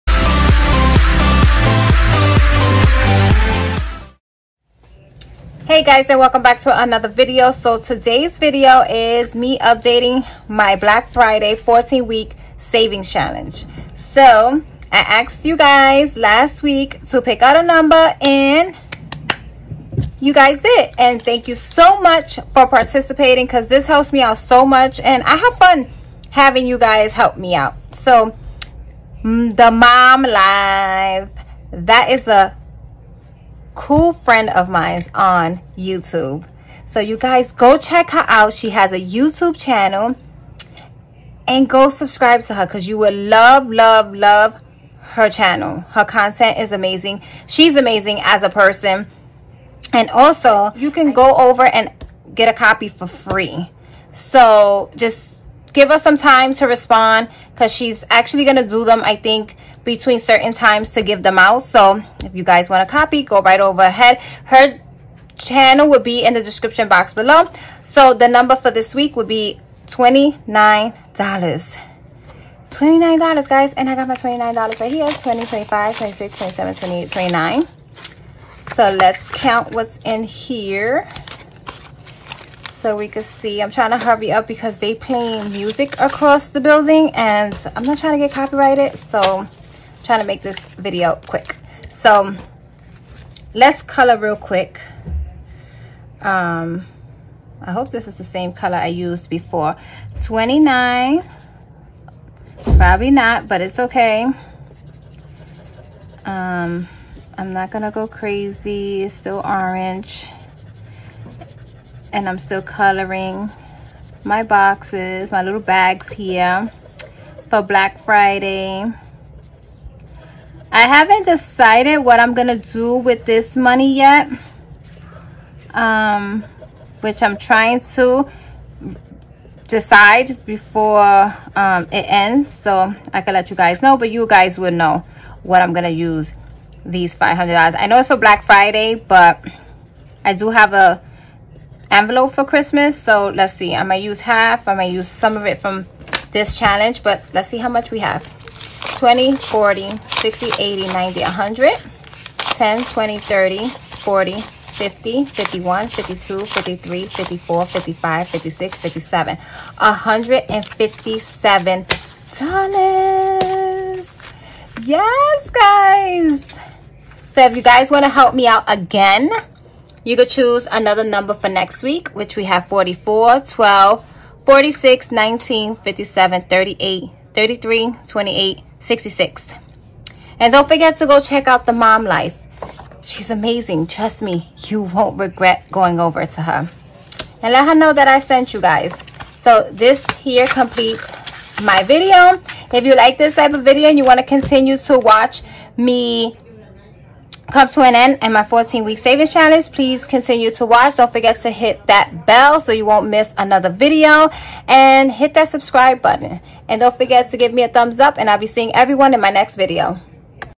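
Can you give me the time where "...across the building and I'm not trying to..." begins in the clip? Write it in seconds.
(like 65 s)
85 s.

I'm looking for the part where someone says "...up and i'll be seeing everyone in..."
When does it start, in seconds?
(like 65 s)
207 s.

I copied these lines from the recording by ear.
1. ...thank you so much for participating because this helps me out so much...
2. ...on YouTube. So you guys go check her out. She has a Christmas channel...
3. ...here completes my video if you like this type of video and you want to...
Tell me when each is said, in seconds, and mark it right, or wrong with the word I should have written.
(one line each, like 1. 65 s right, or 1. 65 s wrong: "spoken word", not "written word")
1. 21 s right
2. 35 s wrong: "YouTube", not "Christmas"
3. 190 s right.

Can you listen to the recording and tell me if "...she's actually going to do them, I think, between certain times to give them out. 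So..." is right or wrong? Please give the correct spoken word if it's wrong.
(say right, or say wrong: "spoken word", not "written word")
right.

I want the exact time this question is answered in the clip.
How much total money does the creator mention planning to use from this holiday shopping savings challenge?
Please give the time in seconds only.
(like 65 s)
137 s.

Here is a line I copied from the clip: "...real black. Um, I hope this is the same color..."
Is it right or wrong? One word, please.
wrong.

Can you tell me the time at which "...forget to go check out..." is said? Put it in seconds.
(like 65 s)
180 s.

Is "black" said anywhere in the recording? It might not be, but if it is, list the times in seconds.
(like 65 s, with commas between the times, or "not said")
10 s, 117 s, 138 s.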